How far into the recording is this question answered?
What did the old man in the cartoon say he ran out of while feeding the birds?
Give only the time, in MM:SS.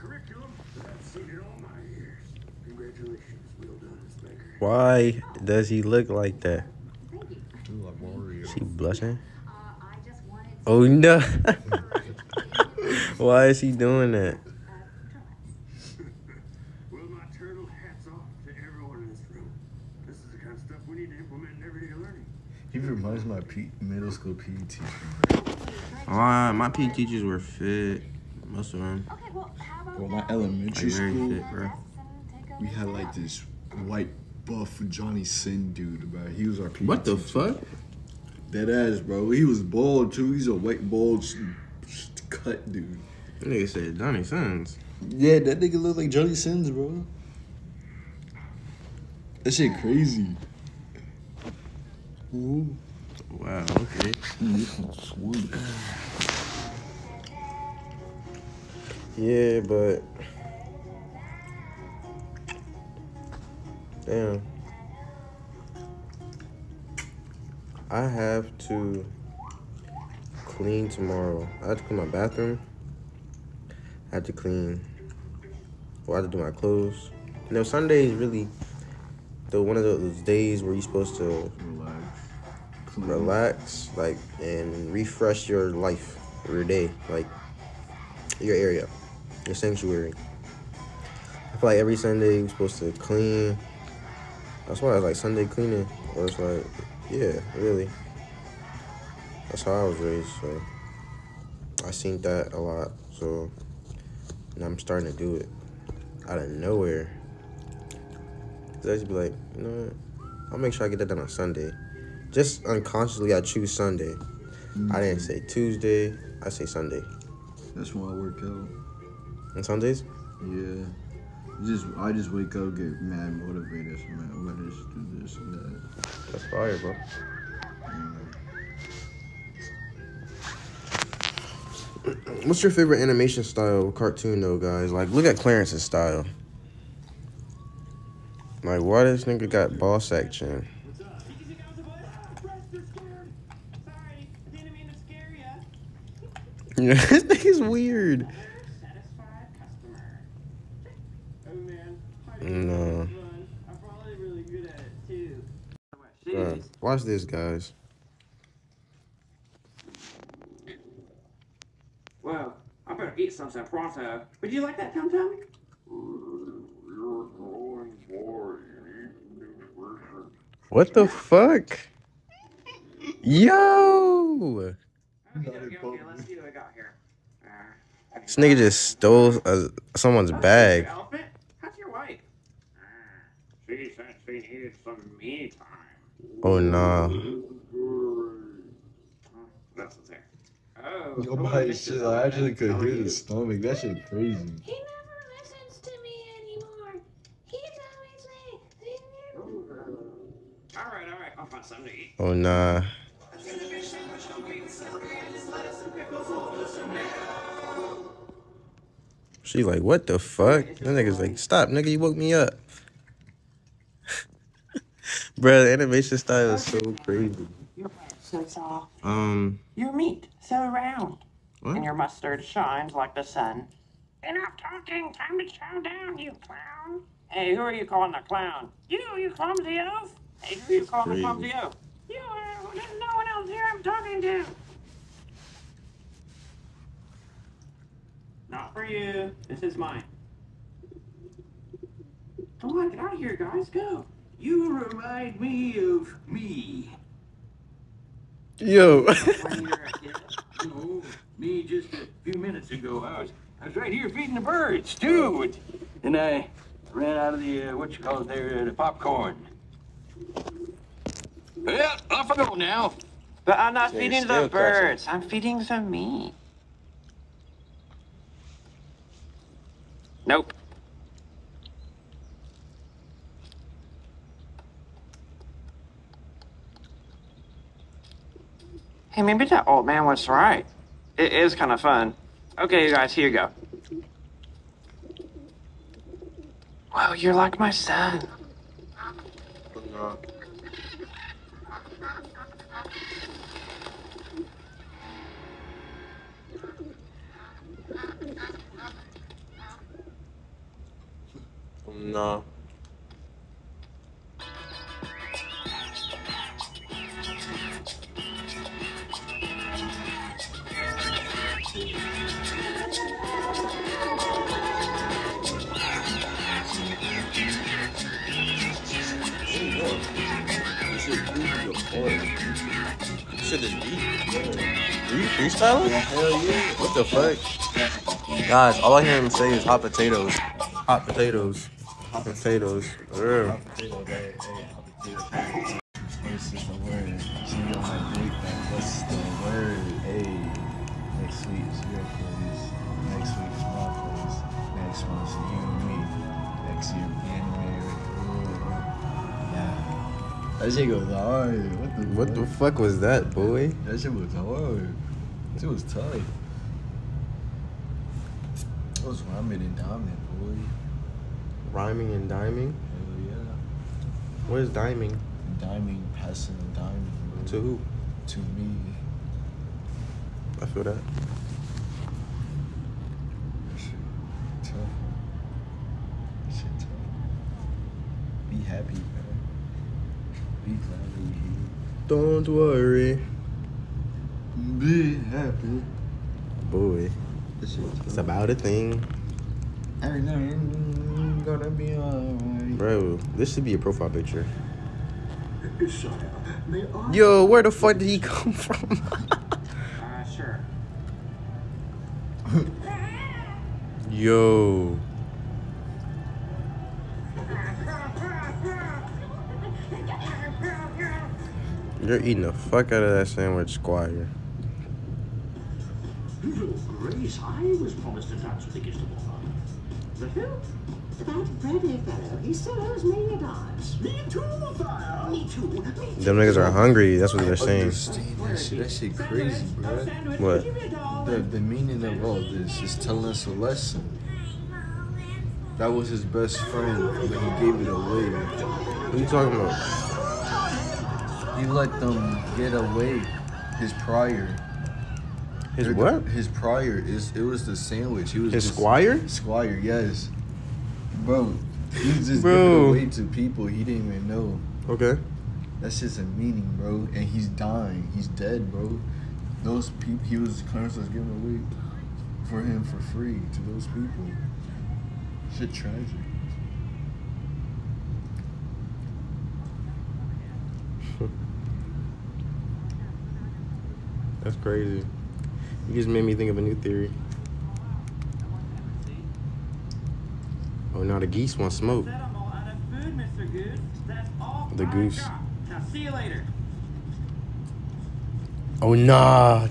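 04:18.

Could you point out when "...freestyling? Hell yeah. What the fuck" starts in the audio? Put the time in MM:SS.
05:25.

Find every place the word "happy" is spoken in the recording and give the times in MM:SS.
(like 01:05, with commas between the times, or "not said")
06:18, 06:25.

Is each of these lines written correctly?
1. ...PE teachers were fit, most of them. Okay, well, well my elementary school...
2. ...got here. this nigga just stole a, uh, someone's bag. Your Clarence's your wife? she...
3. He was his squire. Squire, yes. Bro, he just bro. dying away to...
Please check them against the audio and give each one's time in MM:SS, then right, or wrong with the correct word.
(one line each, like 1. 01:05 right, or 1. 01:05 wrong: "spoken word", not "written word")
1. 00:26 right
2. 02:56 wrong: "How", not "Clarence"
3. 07:28 wrong: "giving", not "dying".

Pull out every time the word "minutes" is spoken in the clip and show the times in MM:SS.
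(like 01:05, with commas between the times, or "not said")
04:12.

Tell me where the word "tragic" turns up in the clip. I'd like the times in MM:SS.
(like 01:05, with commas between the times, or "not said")
07:45.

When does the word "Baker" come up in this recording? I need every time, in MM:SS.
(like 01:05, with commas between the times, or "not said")
00:04.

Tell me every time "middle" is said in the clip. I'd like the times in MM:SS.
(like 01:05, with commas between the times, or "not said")
00:23.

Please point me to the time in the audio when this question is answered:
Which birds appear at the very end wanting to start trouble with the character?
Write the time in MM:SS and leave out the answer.
08:01.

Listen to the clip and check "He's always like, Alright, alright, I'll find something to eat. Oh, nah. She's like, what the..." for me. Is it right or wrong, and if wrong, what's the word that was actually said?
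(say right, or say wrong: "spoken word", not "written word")
right.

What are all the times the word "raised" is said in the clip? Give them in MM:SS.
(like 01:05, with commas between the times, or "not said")
01:39.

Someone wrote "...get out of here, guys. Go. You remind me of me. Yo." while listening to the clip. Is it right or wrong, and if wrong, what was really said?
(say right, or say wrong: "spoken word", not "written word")
right.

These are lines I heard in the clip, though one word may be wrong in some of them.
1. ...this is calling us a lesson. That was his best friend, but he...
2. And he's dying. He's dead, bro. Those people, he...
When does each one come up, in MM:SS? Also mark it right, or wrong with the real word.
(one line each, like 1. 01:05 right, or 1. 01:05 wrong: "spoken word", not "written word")
1. 07:12 wrong: "telling", not "calling"
2. 07:37 right.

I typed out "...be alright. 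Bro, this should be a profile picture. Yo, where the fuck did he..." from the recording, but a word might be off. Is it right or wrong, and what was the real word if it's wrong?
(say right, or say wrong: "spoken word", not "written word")
right.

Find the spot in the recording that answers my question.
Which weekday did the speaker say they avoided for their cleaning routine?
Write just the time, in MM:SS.
01:55.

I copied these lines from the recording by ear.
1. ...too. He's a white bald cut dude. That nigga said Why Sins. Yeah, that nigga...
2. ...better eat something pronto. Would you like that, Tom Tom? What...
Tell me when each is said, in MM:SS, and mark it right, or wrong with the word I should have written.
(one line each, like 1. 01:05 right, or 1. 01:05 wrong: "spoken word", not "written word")
1. 00:40 wrong: "Johnny", not "Why"
2. 02:42 right.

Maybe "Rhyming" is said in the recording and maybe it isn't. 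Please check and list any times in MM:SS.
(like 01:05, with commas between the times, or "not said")
06:01.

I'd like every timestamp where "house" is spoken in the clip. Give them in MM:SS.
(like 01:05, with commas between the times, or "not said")
not said.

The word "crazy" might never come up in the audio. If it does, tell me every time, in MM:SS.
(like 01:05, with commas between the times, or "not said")
00:49, 03:14, 03:37, 07:09, 07:54.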